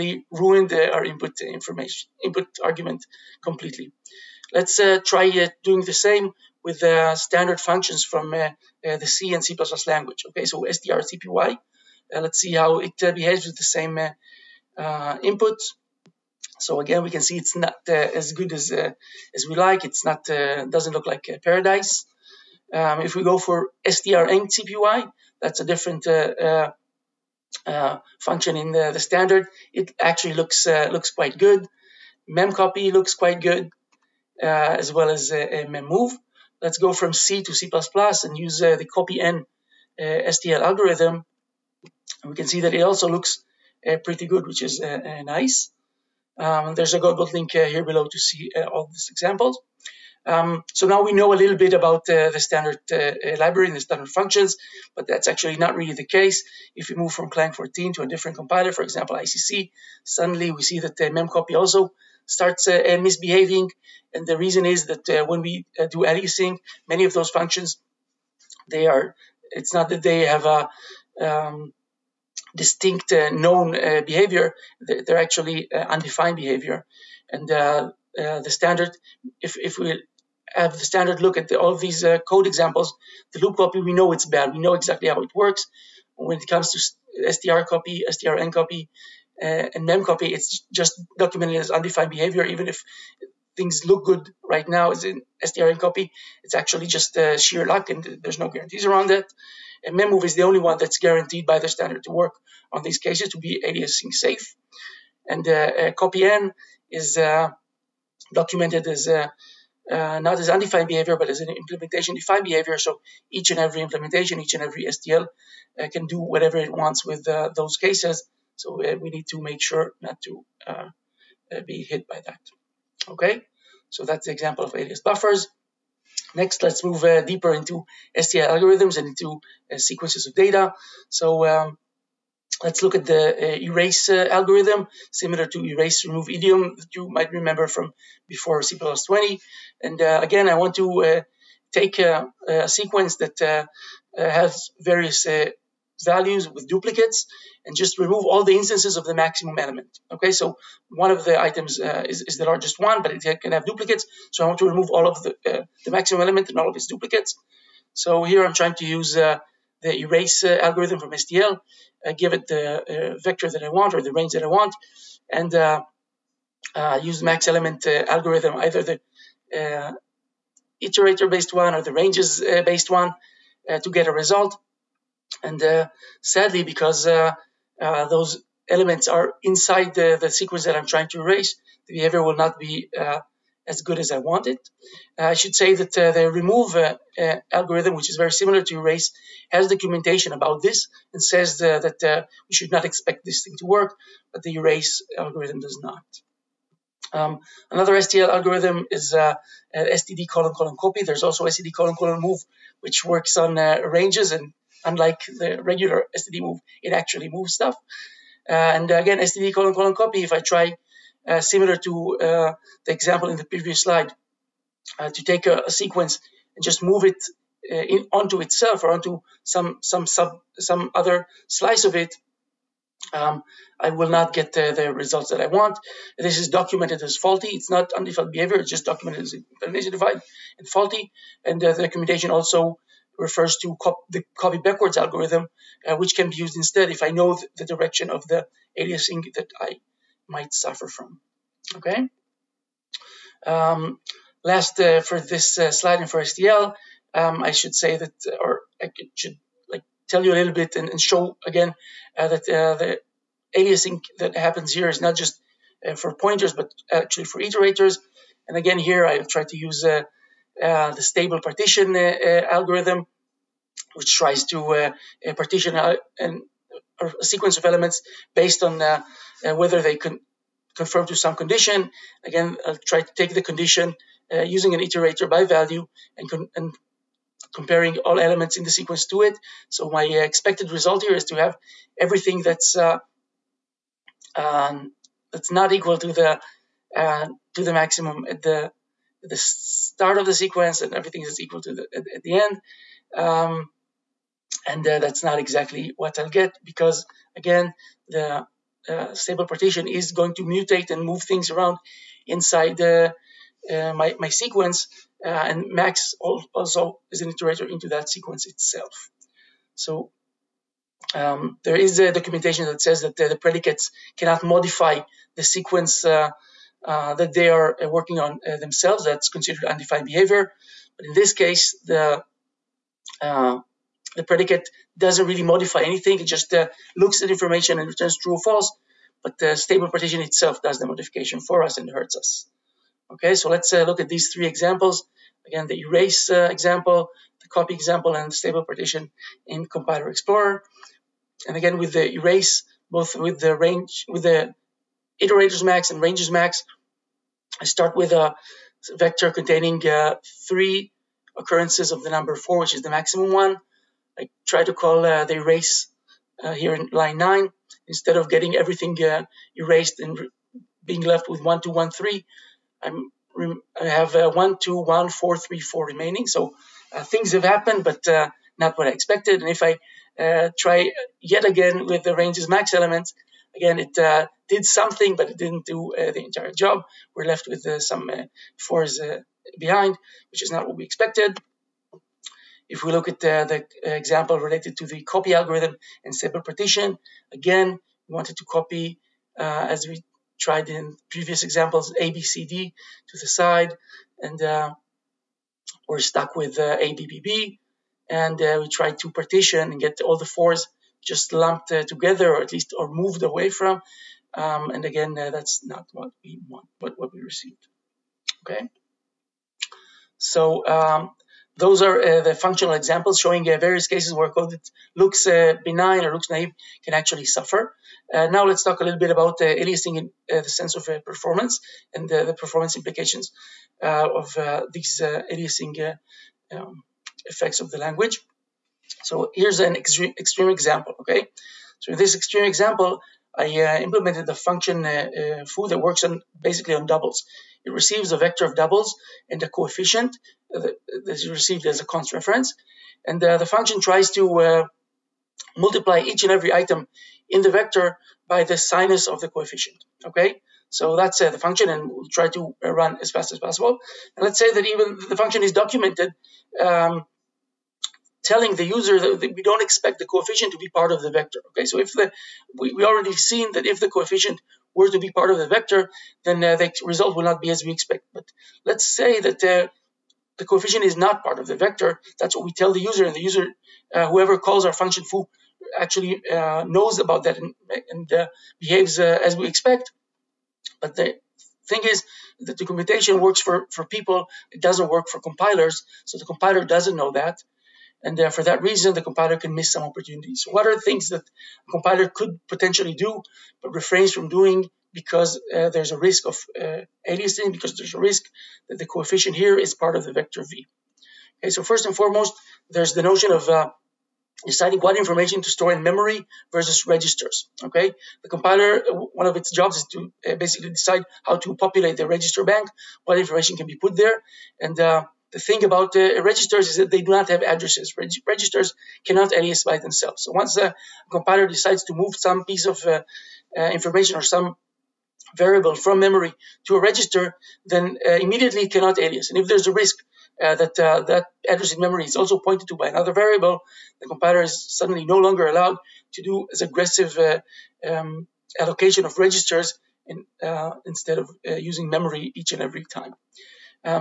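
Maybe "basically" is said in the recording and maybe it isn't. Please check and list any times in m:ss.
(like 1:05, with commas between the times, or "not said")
7:16, 8:30.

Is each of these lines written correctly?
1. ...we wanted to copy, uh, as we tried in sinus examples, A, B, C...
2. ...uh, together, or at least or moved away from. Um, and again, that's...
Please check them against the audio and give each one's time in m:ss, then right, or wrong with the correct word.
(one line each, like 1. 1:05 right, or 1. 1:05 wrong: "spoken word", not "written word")
1. 6:28 wrong: "previous", not "sinus"
2. 6:41 right.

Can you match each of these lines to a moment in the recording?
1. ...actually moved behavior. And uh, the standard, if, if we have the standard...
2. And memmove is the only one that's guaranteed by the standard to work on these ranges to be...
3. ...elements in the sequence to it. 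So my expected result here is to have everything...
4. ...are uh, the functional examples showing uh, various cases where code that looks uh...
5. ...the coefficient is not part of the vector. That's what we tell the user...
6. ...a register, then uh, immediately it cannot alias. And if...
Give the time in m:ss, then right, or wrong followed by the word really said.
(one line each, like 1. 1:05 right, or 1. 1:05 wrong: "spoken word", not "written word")
1. 1:15 wrong: "undefined", not "moved"
2. 1:39 wrong: "cases", not "ranges"
3. 4:38 right
4. 6:51 right
5. 7:50 right
6. 8:46 right.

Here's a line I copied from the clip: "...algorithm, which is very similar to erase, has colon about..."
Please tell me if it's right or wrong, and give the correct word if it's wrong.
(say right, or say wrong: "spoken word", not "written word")
wrong: "documentation", not "colon".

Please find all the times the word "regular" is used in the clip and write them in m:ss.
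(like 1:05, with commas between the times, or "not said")
3:25.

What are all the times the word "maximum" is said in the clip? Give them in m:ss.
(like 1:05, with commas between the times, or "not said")
2:29, 2:35, 4:47, 5:52.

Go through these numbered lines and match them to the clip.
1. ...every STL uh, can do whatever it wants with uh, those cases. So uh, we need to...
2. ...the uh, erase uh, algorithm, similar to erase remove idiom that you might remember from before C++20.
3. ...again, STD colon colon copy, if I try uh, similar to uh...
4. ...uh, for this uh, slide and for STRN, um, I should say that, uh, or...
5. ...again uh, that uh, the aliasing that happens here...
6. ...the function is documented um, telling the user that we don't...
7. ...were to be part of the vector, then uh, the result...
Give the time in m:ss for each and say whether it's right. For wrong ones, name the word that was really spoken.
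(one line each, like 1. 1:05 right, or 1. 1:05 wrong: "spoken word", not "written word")
1. 1:54 right
2. 2:13 right
3. 3:28 right
4. 4:04 wrong: "STL", not "STRN"
5. 4:11 right
6. 7:35 right
7. 7:44 right.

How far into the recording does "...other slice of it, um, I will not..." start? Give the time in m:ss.
3:40.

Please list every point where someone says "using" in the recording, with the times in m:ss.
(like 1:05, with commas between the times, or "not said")
4:34, 9:01.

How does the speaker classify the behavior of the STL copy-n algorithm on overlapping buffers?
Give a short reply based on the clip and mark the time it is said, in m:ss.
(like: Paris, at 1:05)
implementation defined, at 1:51.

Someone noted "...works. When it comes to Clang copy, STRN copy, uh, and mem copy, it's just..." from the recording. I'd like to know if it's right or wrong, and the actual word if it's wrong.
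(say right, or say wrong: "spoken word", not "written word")
wrong: "STR", not "Clang".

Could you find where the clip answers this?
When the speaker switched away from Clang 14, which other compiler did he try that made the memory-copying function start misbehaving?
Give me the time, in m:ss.
0:59.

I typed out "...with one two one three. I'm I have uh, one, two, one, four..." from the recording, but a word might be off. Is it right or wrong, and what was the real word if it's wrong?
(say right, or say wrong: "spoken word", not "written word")
right.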